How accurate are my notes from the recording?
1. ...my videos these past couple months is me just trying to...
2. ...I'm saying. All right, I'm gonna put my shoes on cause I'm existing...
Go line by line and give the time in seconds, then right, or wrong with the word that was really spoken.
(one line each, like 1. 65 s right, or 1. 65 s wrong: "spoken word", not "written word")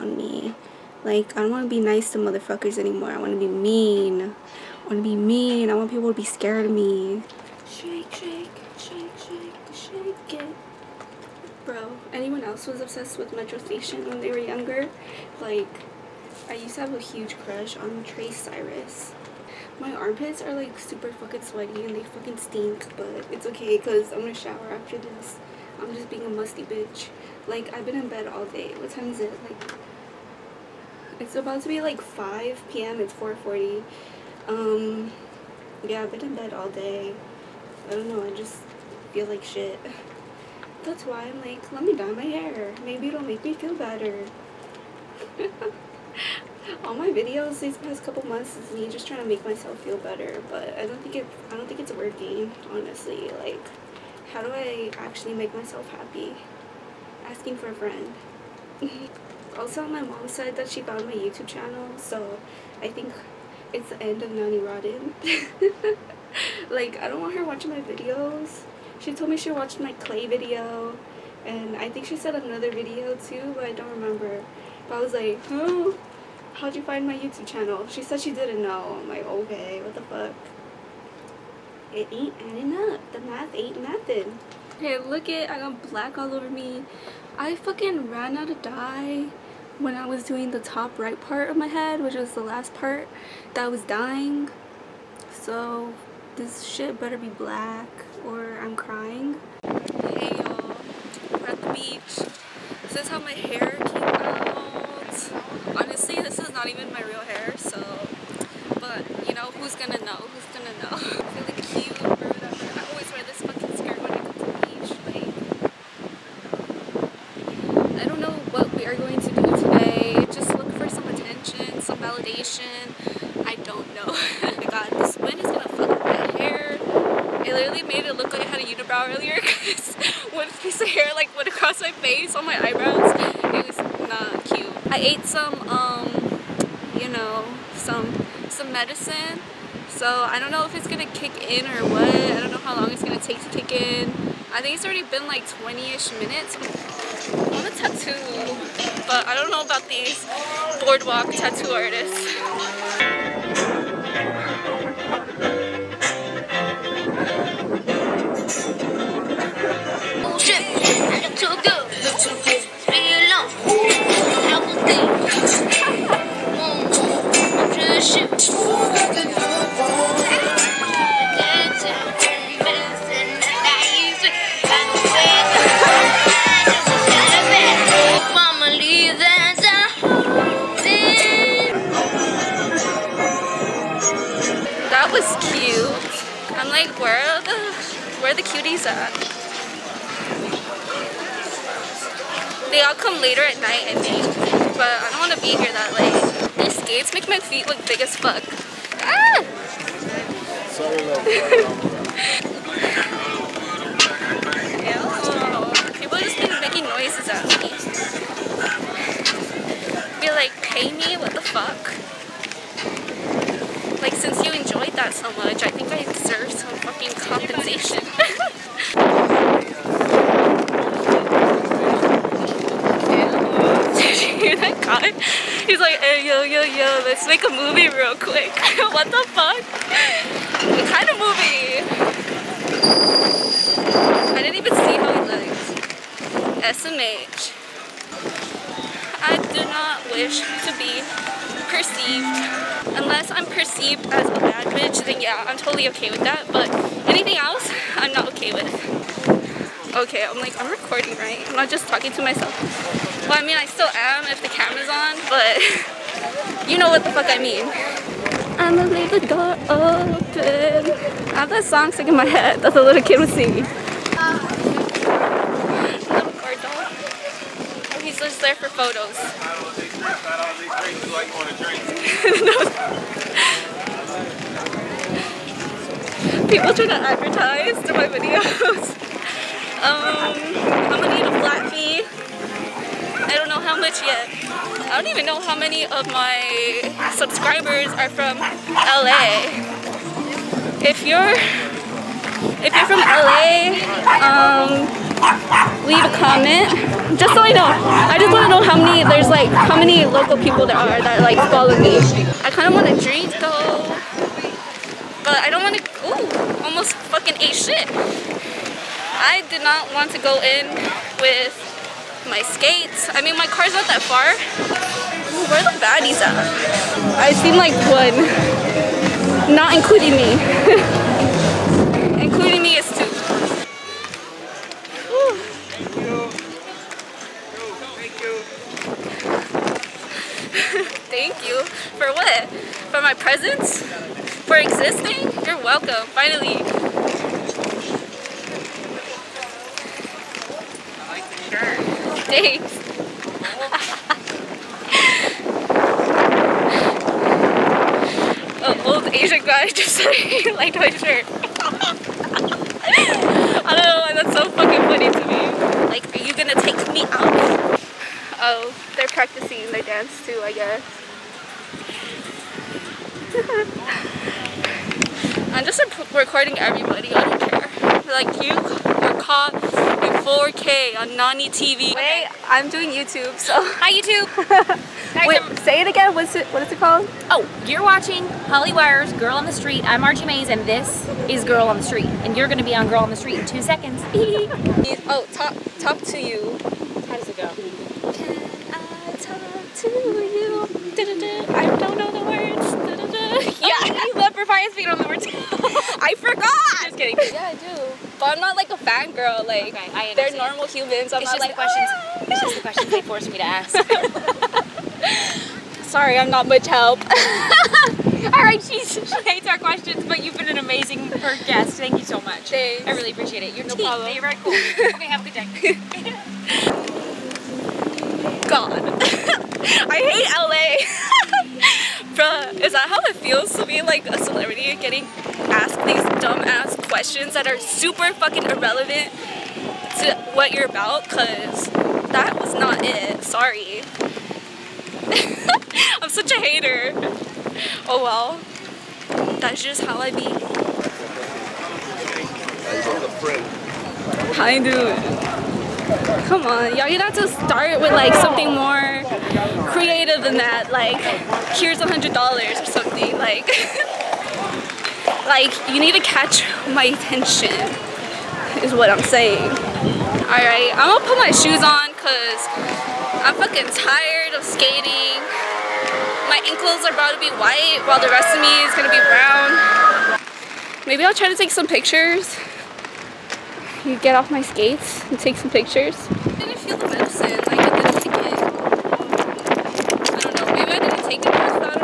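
1. 46 s right
2. 458 s wrong: "fucking", not "existing".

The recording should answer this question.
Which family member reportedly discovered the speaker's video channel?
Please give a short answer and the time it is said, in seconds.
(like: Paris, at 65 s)
Mom, at 59 s.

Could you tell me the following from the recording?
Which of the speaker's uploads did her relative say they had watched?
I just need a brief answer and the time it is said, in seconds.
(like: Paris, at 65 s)
Clay video, at 69 s.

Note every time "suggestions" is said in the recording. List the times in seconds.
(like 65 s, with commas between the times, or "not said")
not said.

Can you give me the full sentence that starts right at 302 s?
I kind of want to drink though, but I don't want to.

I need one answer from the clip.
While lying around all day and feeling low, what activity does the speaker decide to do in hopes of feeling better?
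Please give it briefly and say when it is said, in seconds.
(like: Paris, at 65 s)
Dye my hair, at 41 s.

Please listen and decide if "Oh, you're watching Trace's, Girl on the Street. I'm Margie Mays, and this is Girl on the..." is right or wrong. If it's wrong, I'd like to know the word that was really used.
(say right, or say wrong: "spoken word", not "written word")
wrong: "Hollywire", not "Trace".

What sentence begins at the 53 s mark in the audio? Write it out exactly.
Like how do I actually make myself happy?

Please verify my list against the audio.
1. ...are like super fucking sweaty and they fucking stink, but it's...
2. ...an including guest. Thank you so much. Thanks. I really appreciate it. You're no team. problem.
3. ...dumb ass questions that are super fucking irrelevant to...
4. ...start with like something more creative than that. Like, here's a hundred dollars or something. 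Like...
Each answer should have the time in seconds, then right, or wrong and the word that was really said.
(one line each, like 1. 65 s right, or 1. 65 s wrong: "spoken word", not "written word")
1. 20 s right
2. 410 s wrong: "amazing", not "including"
3. 426 s right
4. 447 s right.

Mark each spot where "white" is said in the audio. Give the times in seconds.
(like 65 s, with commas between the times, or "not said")
467 s.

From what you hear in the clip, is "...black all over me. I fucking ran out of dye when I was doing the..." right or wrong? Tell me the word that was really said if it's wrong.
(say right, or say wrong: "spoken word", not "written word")
right.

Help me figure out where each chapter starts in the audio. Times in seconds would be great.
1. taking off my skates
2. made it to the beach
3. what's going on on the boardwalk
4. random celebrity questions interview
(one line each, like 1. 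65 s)
1. 439 s
2. 98 s
3. 152 s
4. 370 s.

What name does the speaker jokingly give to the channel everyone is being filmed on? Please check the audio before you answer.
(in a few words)
Nani TV.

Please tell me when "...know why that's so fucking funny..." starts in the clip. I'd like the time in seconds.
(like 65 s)
353 s.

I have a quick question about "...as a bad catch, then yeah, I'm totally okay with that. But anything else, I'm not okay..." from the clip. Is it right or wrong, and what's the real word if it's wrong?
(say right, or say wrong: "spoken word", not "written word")
wrong: "bitch", not "catch".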